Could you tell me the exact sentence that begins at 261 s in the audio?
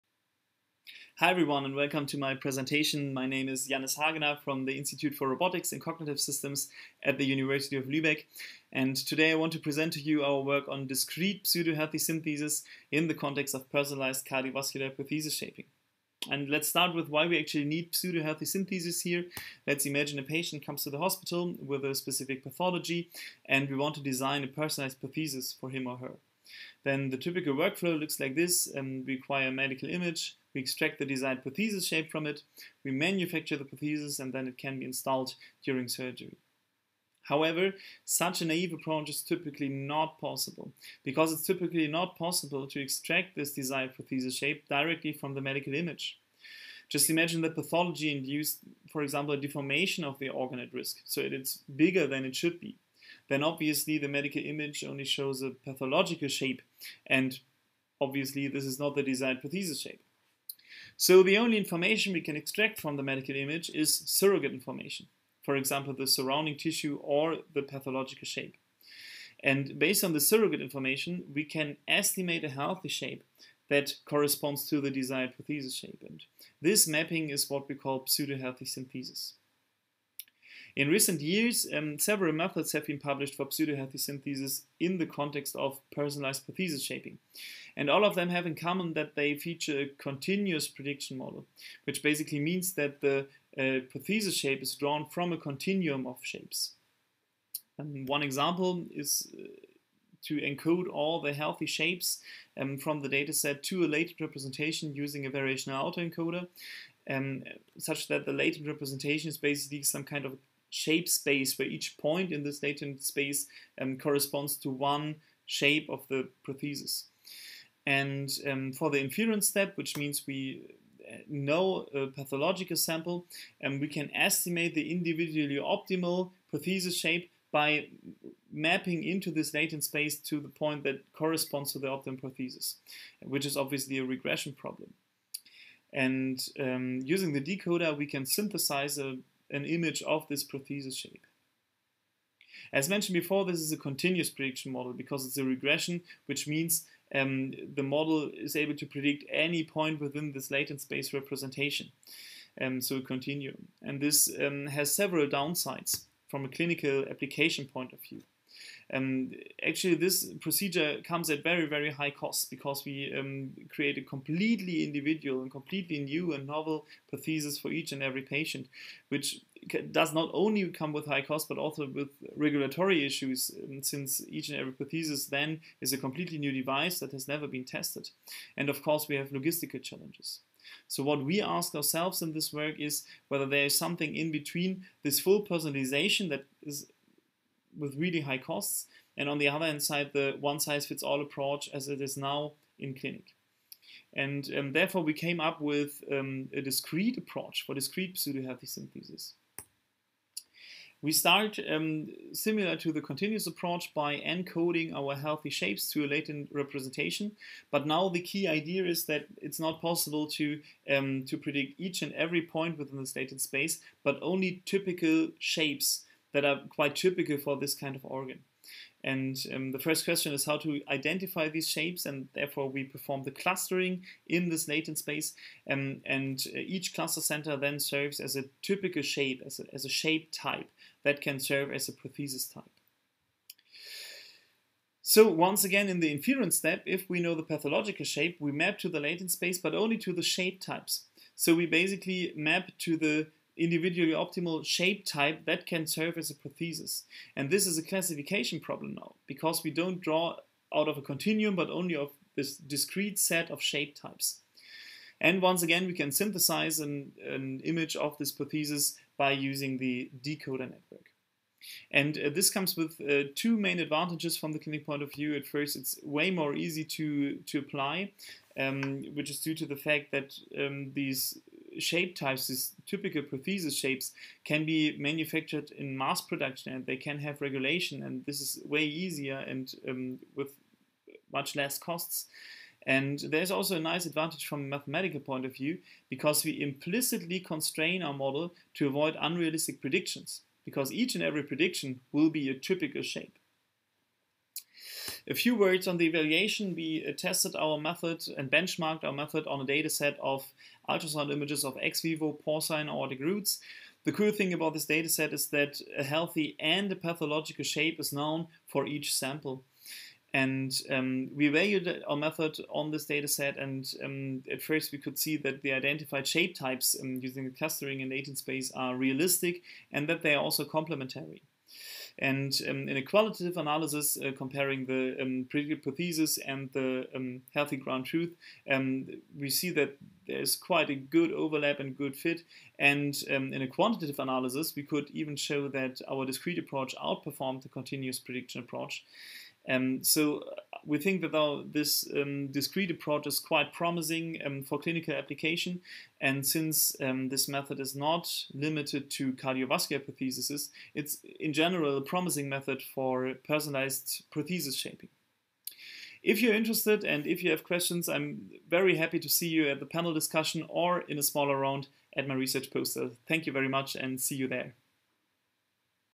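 And uh, this comes with uh, two main advantages from the clinic point of view.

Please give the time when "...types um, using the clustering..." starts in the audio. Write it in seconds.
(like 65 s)
316 s.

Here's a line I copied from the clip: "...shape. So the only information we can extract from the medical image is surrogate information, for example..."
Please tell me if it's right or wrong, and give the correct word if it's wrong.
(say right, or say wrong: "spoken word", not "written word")
right.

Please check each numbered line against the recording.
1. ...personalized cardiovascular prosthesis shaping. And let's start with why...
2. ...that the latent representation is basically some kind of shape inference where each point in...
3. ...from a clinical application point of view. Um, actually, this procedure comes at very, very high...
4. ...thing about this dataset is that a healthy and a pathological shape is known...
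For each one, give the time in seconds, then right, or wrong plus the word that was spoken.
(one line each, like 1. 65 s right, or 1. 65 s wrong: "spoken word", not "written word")
1. 13 s right
2. 108 s wrong: "space", not "inference"
3. 156 s right
4. 304 s right.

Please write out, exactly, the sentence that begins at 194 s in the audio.
And um, therefore, we came up with um, a discrete approach for discrete pseudohealthy synthesis.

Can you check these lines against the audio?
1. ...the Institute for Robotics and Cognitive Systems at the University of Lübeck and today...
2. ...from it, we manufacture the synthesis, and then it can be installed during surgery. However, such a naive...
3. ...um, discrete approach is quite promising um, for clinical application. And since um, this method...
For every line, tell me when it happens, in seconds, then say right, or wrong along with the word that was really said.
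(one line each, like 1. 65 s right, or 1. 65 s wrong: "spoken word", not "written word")
1. 4 s right
2. 32 s wrong: "prosthesis", not "synthesis"
3. 342 s right.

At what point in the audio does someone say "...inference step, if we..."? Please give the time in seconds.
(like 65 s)
236 s.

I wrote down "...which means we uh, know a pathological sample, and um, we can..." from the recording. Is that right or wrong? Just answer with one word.
right.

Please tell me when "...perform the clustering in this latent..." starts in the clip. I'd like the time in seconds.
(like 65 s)
222 s.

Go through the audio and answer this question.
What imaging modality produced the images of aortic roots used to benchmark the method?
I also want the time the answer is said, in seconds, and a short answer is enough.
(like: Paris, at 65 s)
ultrasound, at 300 s.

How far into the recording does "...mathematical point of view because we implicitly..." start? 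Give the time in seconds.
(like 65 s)
284 s.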